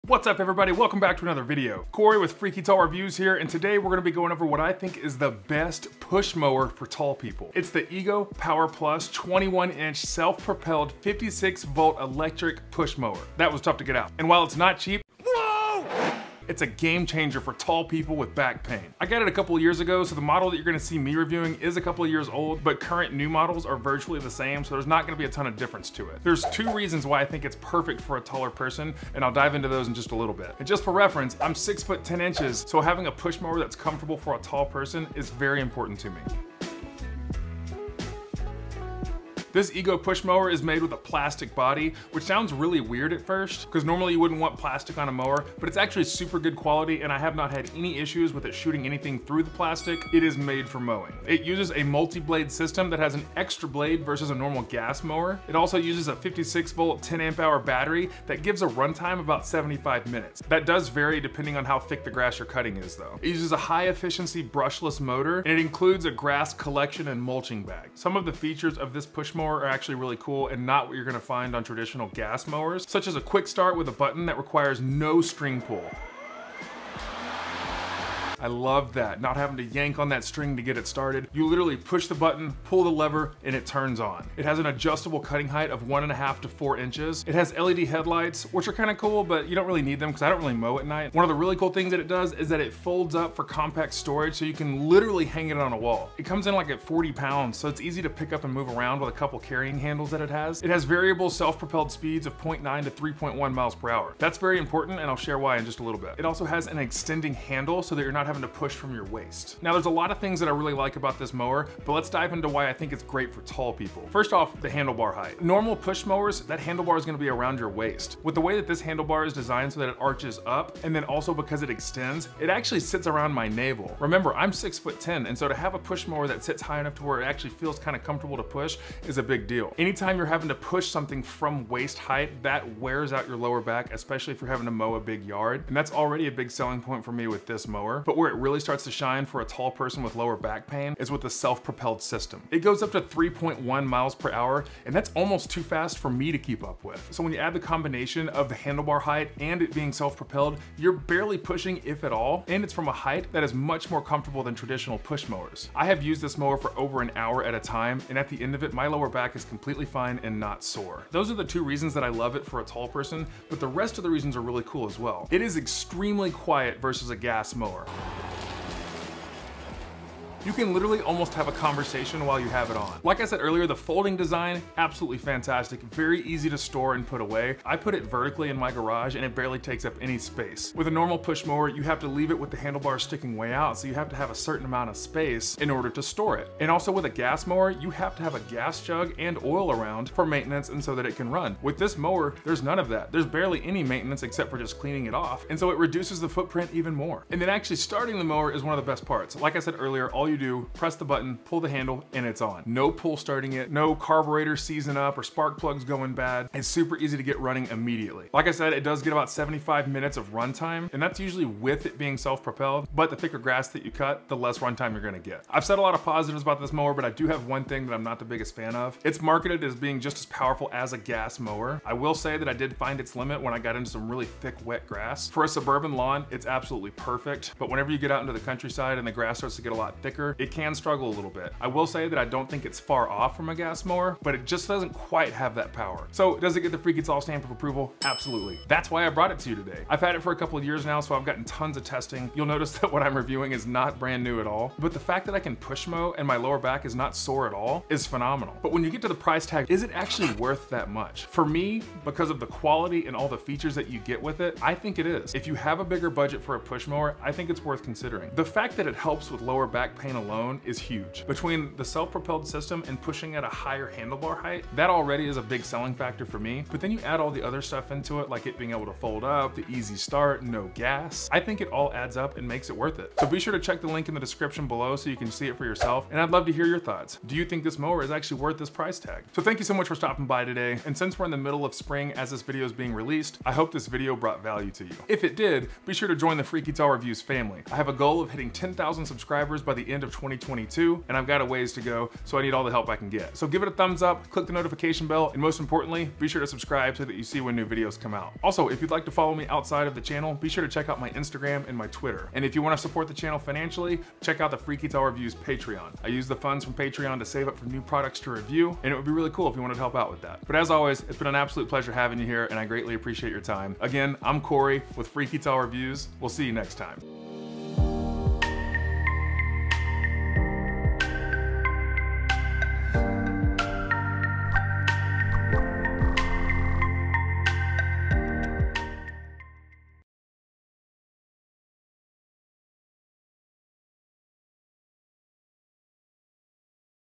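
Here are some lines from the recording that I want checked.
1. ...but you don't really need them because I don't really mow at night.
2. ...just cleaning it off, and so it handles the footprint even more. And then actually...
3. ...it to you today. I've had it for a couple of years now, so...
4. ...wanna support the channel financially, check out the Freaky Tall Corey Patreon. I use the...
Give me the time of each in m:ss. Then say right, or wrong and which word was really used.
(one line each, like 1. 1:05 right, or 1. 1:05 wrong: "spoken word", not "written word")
1. 1:29 right
2. 3:14 wrong: "reduces", not "handles"
3. 3:59 right
4. 5:02 wrong: "Reviews", not "Corey".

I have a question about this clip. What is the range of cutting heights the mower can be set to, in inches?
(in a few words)
1.5 to 4 inches.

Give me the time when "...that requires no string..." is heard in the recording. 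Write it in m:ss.
1:14.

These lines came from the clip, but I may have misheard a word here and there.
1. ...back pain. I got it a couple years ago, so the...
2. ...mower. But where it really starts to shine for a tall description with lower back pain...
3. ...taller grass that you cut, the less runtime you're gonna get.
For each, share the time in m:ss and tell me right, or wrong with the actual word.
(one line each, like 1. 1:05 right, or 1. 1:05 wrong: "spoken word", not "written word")
1. 0:18 right
2. 2:17 wrong: "person", not "description"
3. 3:33 wrong: "thicker", not "taller".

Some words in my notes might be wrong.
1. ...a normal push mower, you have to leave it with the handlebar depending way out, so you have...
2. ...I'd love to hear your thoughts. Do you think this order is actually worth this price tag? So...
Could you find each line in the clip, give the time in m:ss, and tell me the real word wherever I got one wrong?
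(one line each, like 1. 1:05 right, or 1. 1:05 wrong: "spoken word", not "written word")
1. 3:00 wrong: "sticking", not "depending"
2. 4:36 wrong: "mower", not "order".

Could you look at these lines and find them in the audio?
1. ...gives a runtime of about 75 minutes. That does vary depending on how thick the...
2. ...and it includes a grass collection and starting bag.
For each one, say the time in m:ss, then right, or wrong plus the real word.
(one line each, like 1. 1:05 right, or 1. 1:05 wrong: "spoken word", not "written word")
1. 0:58 right
2. 1:05 wrong: "mulching", not "starting".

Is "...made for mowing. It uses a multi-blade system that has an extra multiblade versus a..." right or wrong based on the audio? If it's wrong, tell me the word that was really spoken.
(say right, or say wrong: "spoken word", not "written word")
wrong: "blade", not "multiblade".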